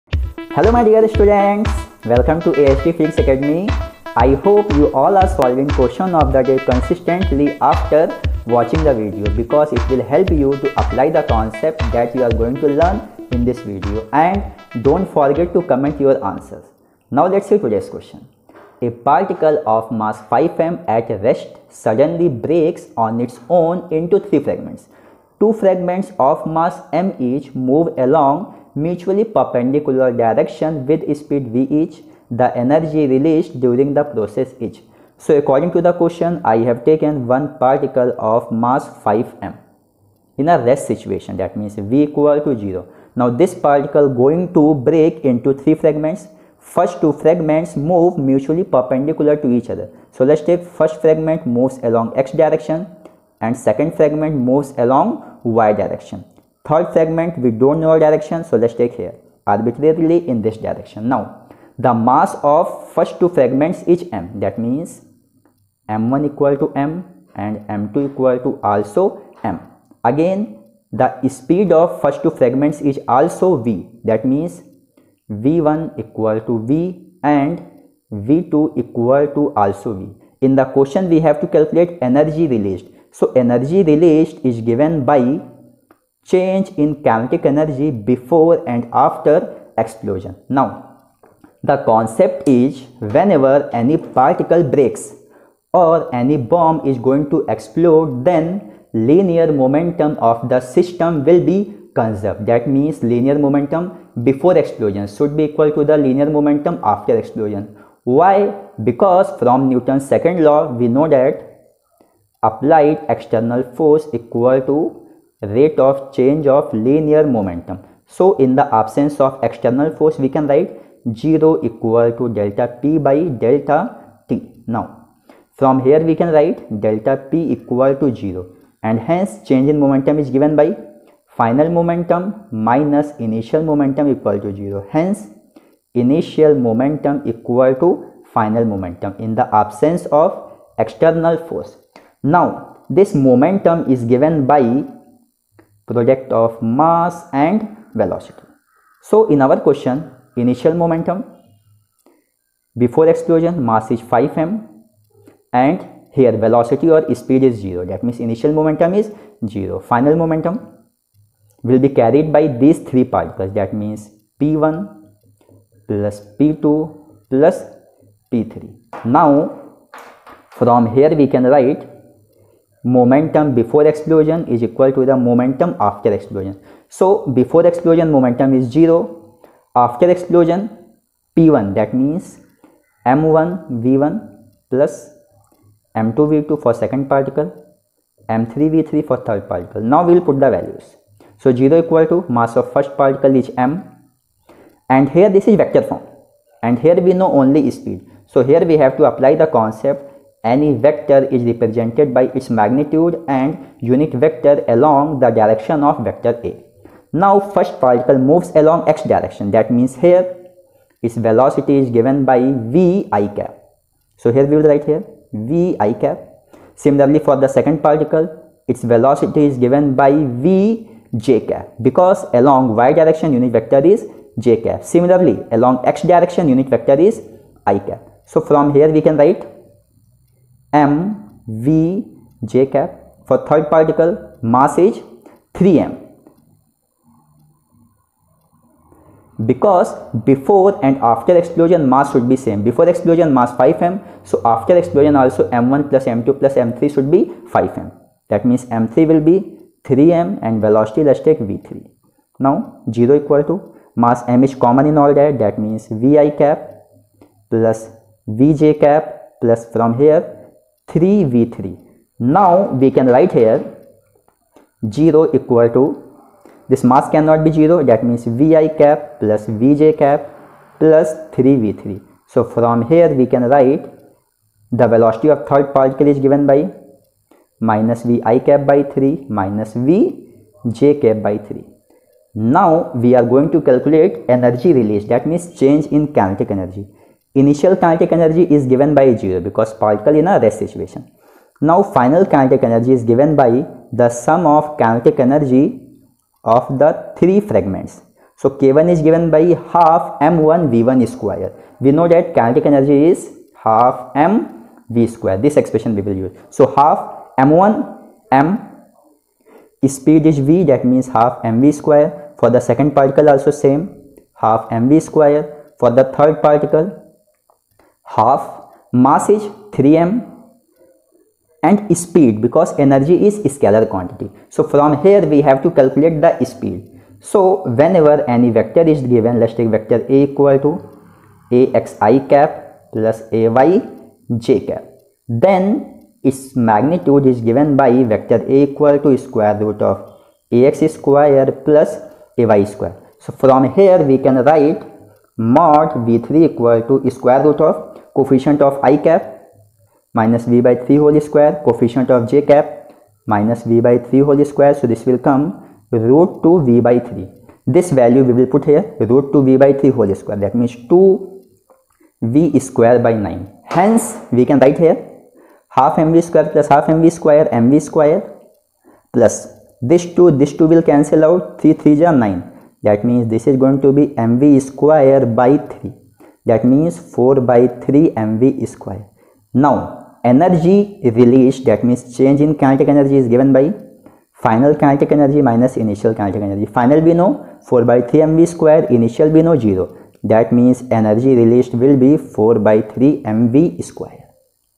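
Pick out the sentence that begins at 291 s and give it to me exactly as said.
Now final kinetic energy is given by the sum of kinetic energy of the three fragments.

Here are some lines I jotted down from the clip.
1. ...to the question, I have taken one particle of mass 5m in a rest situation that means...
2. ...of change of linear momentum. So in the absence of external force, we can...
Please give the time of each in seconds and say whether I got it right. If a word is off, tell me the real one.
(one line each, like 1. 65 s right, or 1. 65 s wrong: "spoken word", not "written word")
1. 35 s right
2. 115 s right.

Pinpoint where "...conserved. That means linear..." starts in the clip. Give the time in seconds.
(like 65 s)
101 s.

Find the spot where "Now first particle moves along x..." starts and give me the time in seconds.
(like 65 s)
207 s.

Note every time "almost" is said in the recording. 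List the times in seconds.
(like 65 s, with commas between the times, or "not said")
not said.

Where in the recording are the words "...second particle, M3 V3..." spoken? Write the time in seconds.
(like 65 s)
186 s.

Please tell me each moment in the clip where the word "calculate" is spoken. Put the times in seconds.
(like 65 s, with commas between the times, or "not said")
81 s, 325 s.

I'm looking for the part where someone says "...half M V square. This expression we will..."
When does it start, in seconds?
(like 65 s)
303 s.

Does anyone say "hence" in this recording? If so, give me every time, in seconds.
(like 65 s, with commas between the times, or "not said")
128 s, 134 s.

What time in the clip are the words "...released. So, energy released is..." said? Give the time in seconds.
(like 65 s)
82 s.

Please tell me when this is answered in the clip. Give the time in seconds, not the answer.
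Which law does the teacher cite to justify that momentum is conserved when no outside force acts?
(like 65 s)
109 s.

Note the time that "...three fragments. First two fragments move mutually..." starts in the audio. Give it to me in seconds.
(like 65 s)
45 s.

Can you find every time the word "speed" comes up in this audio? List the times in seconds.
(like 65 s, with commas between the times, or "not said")
31 s, 71 s, 157 s, 197 s, 309 s, 322 s, 326 s.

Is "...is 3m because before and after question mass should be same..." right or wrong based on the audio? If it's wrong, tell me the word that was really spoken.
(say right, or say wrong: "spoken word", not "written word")
wrong: "explosion", not "question".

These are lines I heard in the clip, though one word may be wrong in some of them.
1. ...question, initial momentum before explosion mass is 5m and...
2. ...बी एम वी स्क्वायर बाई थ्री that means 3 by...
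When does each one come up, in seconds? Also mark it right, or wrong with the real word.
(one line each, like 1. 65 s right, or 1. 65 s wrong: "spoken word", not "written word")
1. 149 s right
2. 373 s wrong: "4", not "3".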